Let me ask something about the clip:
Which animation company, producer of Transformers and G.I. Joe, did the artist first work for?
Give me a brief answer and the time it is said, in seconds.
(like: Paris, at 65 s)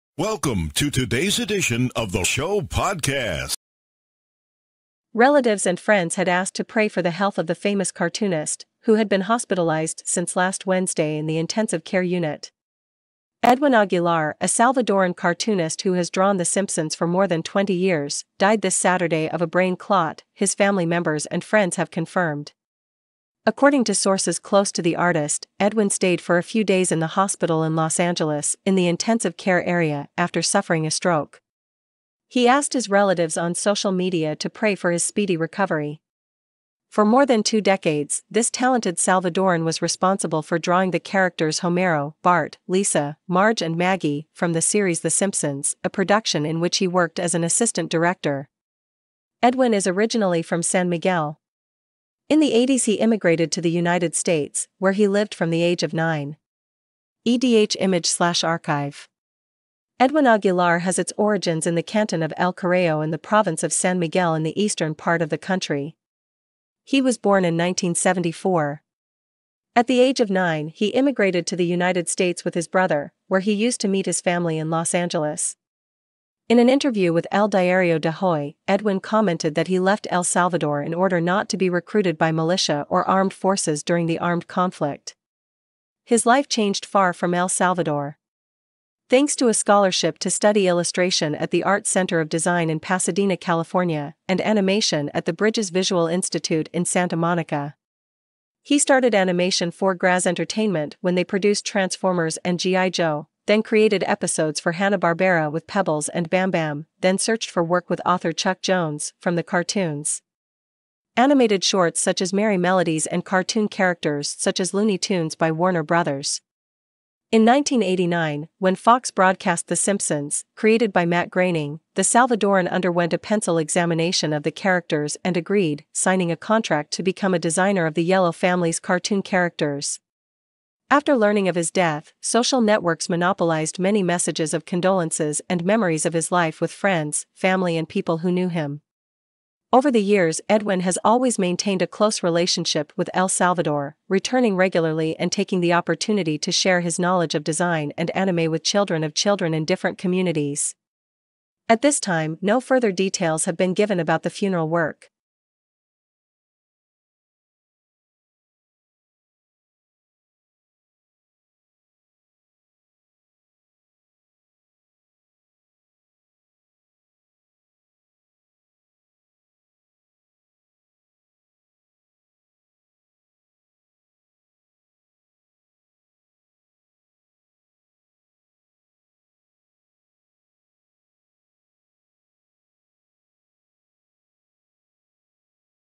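Graz Entertainment, at 99 s.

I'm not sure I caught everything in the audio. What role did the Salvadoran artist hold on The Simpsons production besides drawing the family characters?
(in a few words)
assistant director.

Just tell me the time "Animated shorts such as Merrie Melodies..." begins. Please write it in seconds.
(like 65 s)
111 s.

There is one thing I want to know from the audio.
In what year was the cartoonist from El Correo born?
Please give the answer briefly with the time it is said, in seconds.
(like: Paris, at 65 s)
1974, at 67 s.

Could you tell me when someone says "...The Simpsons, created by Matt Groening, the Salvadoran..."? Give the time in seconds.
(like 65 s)
119 s.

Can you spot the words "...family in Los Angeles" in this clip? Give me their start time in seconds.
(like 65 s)
74 s.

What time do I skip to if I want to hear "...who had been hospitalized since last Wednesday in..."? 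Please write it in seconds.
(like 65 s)
8 s.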